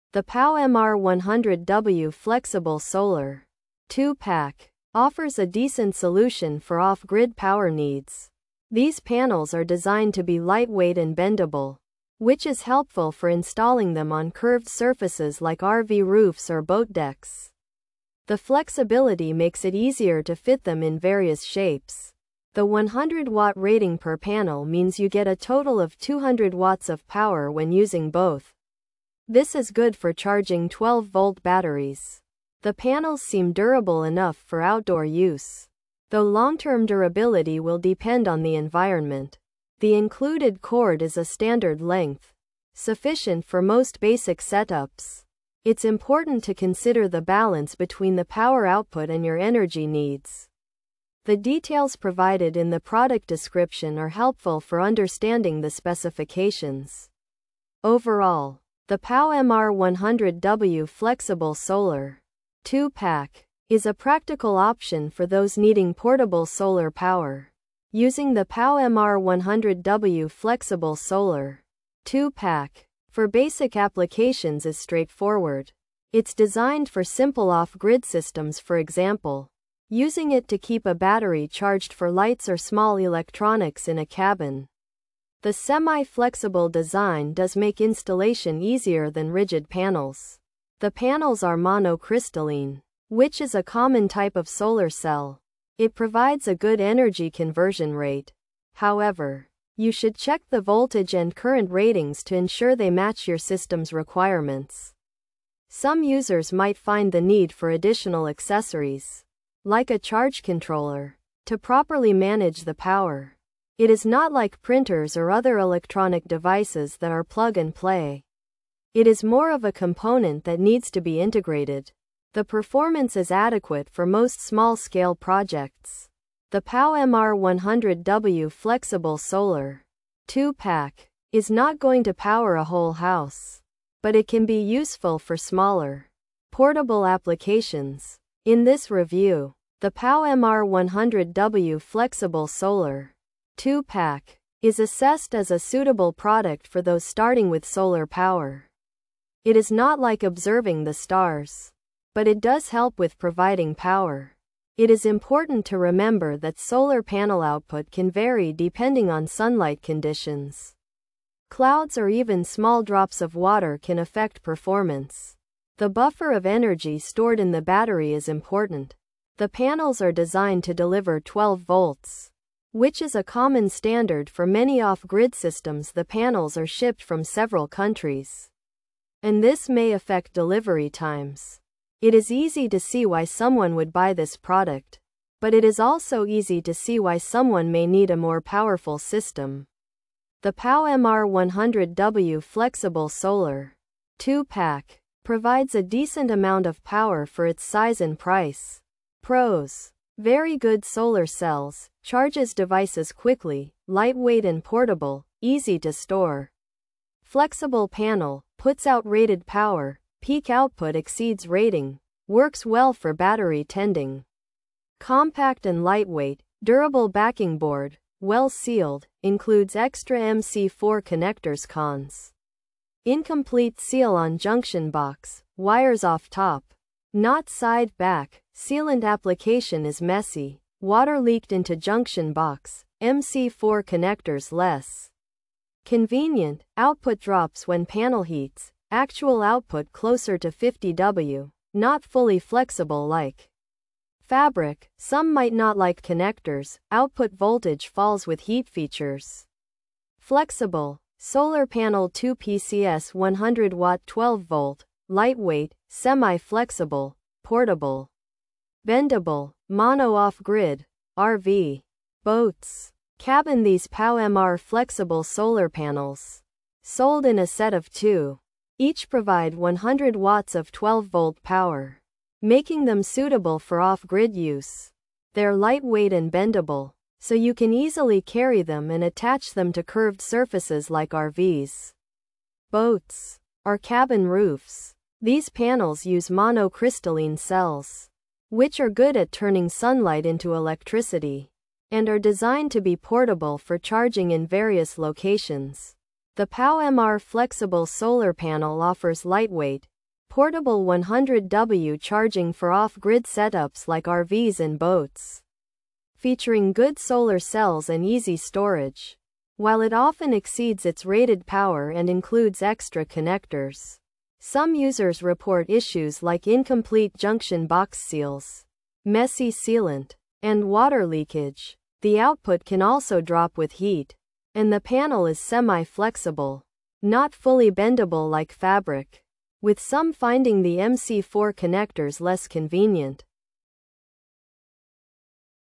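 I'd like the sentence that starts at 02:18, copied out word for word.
In this review, the POW MR100W Flexible Solar 2-pack, is assessed as a suitable product for those starting with solar power.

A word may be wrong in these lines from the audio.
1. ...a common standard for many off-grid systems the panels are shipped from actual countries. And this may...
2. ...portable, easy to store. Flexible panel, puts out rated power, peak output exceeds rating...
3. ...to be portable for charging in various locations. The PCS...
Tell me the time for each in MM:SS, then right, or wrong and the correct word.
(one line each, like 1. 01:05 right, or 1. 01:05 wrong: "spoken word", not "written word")
1. 02:53 wrong: "several", not "actual"
2. 03:24 right
3. 04:52 wrong: "POW", not "PCS".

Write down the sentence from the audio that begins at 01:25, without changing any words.
The semi-flexible design does make installation easier than rigid panels.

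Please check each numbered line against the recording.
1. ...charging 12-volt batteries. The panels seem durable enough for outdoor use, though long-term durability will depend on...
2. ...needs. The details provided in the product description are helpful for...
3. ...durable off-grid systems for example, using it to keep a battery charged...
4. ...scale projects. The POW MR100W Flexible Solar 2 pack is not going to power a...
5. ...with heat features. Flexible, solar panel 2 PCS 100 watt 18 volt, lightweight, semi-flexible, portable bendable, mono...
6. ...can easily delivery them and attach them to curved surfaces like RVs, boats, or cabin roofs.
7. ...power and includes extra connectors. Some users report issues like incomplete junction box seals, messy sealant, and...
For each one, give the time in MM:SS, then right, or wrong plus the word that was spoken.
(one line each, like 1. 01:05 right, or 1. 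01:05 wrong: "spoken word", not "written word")
1. 00:30 right
2. 00:49 right
3. 01:17 wrong: "simple", not "durable"
4. 02:04 right
5. 04:08 wrong: "12", not "18"
6. 04:37 wrong: "carry", not "delivery"
7. 05:11 right.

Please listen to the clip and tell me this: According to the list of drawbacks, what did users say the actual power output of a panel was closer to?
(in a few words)
50 W.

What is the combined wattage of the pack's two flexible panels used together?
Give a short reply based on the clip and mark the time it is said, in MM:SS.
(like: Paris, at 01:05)
200 watts, at 00:25.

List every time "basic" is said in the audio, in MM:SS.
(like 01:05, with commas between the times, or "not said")
00:43, 01:13.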